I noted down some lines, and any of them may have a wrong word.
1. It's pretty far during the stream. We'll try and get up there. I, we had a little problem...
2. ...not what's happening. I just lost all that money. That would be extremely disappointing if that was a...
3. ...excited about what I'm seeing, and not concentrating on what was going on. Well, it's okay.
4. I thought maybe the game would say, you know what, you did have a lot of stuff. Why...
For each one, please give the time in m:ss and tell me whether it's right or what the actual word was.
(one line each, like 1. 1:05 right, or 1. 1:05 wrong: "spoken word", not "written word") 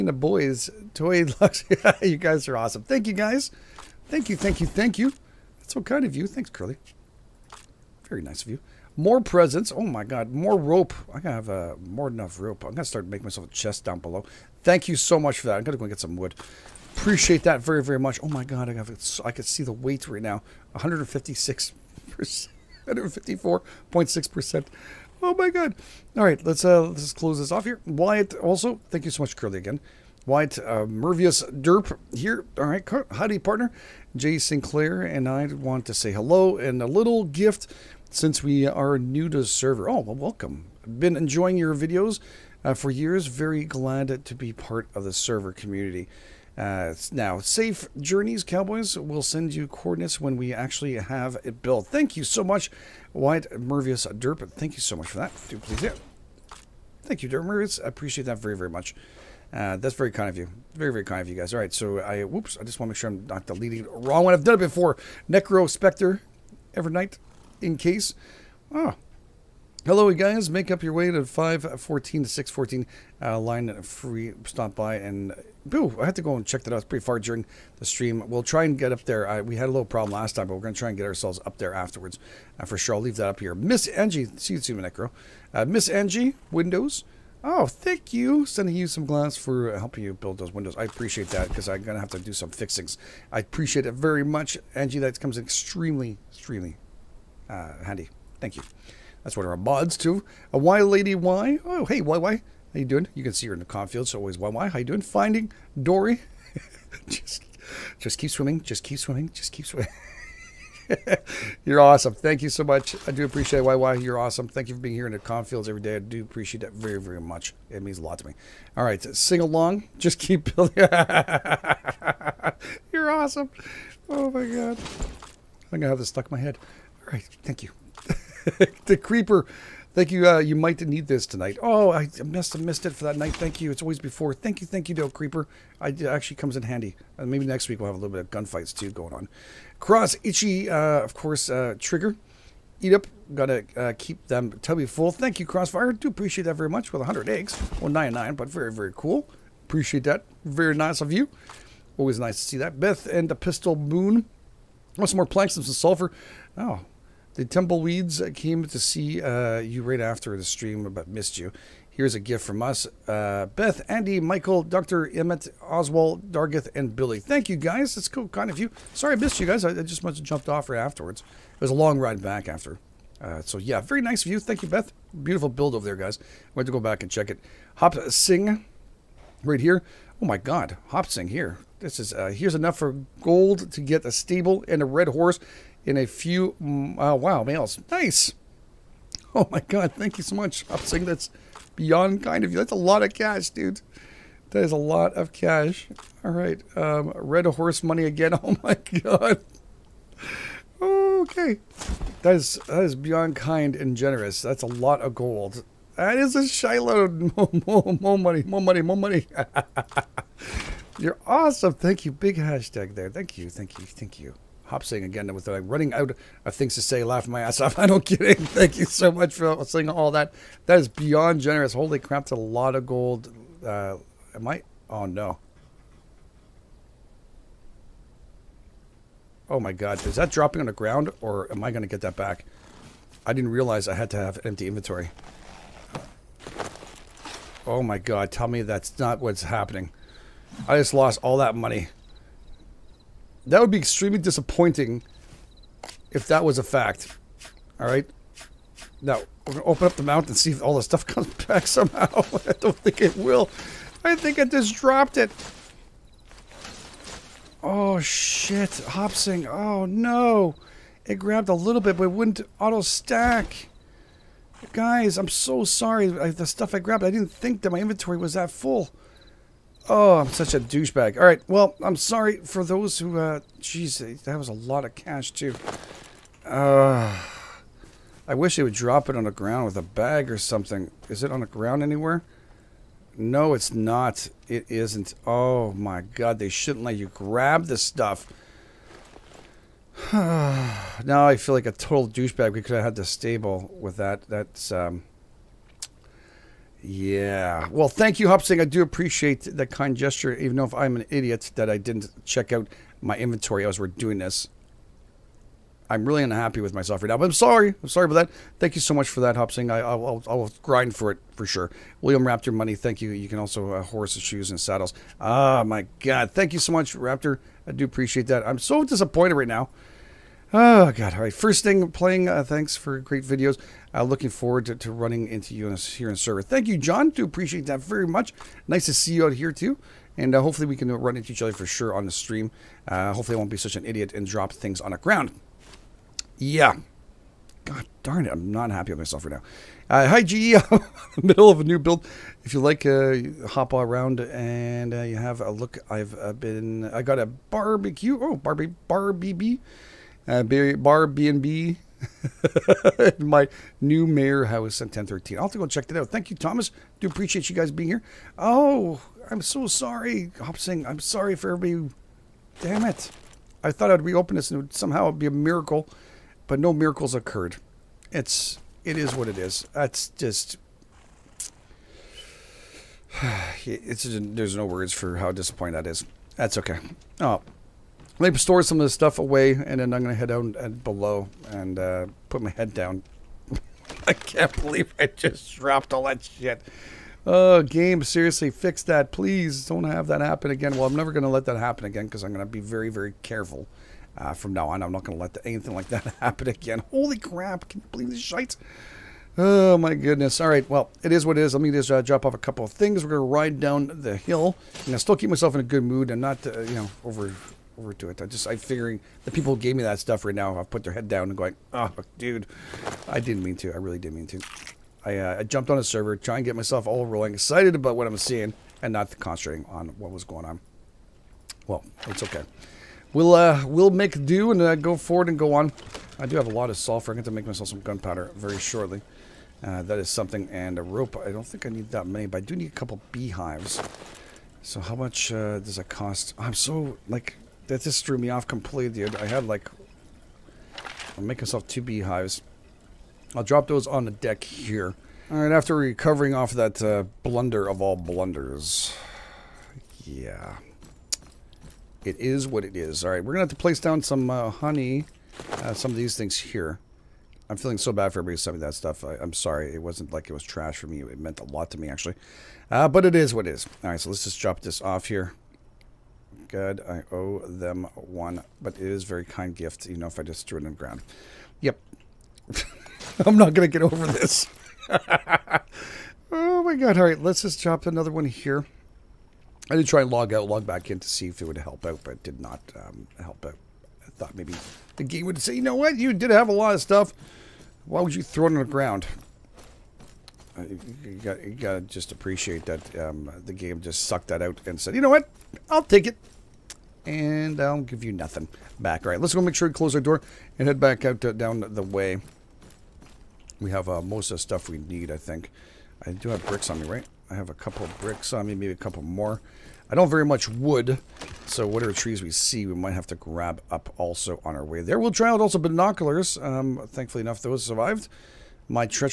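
1. 1:16 right
2. 3:58 right
3. 6:57 right
4. 8:04 right.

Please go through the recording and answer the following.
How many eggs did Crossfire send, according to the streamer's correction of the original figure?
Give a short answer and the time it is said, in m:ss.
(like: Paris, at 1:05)
99, at 2:27.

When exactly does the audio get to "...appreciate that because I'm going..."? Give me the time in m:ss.
1:30.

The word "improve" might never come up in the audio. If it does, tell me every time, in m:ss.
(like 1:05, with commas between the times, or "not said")
not said.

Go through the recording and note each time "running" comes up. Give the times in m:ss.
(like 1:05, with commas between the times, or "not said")
3:35, 5:24.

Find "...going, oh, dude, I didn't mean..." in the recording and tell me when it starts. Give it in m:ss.
6:51.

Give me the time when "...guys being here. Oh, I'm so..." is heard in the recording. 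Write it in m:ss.
5:57.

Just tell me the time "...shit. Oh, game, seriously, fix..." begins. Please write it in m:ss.
6:26.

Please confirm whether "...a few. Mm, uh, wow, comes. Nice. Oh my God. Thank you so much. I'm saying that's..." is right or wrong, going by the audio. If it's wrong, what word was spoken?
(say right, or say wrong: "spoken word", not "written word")
wrong: "males", not "comes".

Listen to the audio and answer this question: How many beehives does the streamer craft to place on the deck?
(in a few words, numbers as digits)
2.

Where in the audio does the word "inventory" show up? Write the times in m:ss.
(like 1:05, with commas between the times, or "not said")
3:54, 4:27, 5:03.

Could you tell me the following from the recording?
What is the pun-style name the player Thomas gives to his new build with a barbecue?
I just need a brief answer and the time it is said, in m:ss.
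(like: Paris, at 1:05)
Bar B&B, at 5:50.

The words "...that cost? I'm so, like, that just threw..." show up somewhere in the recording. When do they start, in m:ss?
7:15.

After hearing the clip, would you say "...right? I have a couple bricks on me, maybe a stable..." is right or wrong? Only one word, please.
wrong.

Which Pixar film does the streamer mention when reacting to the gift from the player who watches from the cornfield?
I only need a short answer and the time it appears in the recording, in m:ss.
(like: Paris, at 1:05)
Finding Dory, at 1:45.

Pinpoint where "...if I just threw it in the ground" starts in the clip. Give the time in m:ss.
7:50.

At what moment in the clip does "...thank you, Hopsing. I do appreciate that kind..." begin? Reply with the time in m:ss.
4:57.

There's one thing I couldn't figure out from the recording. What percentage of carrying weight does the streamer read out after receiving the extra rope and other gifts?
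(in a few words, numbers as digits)
154.6 percent.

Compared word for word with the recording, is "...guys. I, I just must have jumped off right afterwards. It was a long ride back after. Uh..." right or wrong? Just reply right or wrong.
right.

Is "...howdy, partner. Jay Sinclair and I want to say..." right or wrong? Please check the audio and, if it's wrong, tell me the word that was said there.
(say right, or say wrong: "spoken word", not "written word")
right.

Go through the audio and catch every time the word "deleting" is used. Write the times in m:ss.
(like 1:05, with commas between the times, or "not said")
1:03.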